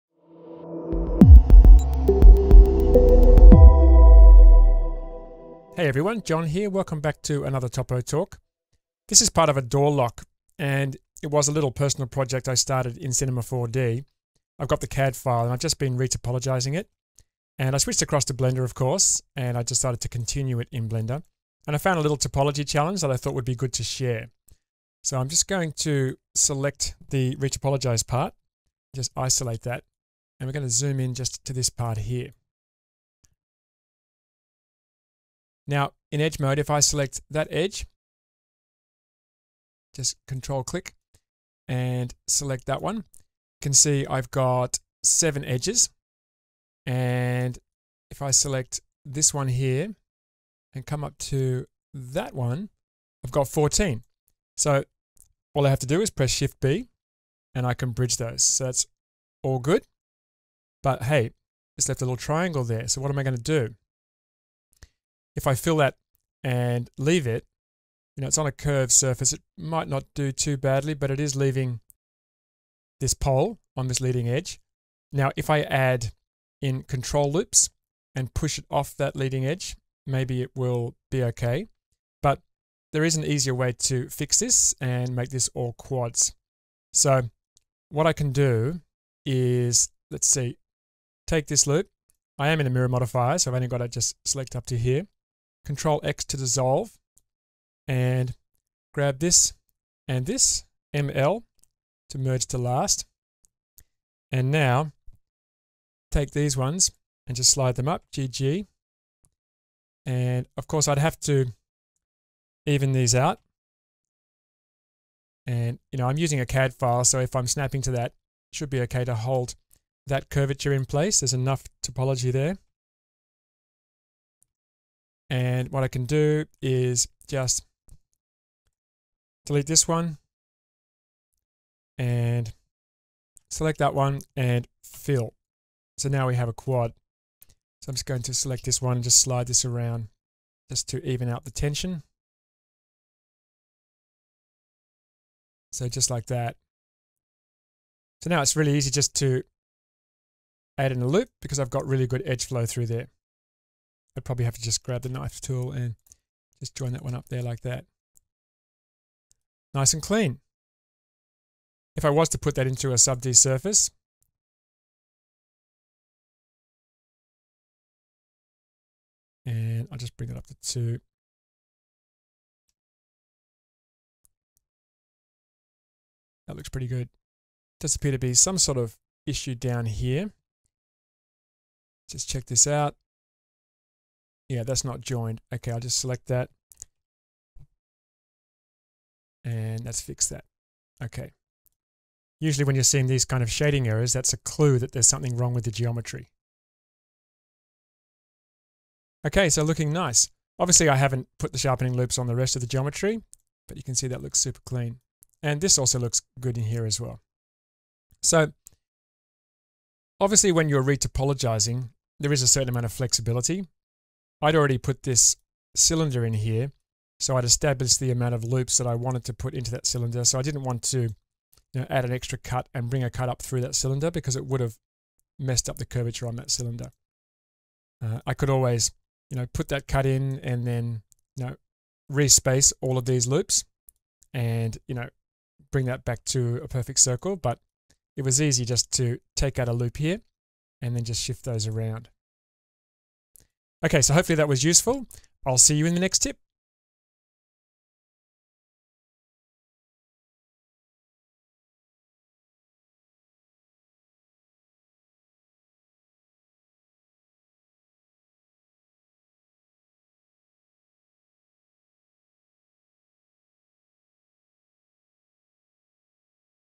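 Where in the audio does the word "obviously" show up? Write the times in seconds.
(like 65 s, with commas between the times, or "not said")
200 s, 210 s.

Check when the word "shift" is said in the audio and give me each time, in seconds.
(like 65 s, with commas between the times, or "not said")
56 s, 241 s.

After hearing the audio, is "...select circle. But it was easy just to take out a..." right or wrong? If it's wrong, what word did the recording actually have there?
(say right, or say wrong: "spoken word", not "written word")
wrong: "perfect", not "select".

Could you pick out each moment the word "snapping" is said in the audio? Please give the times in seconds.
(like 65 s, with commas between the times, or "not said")
117 s.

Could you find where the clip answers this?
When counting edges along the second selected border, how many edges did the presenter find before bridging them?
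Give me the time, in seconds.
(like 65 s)
53 s.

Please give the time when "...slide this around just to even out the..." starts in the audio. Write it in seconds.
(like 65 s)
139 s.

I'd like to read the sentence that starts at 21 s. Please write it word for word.
And I found a little topology challenge that I thought would be good to share.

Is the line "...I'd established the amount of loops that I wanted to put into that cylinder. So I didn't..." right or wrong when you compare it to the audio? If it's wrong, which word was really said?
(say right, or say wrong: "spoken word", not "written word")
right.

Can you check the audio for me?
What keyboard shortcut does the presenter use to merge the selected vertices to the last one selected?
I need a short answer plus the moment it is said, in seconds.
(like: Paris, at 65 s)
ML, at 100 s.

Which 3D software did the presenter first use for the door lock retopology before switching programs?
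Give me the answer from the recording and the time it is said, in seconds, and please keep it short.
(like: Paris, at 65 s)
Cinema 4D, at 13 s.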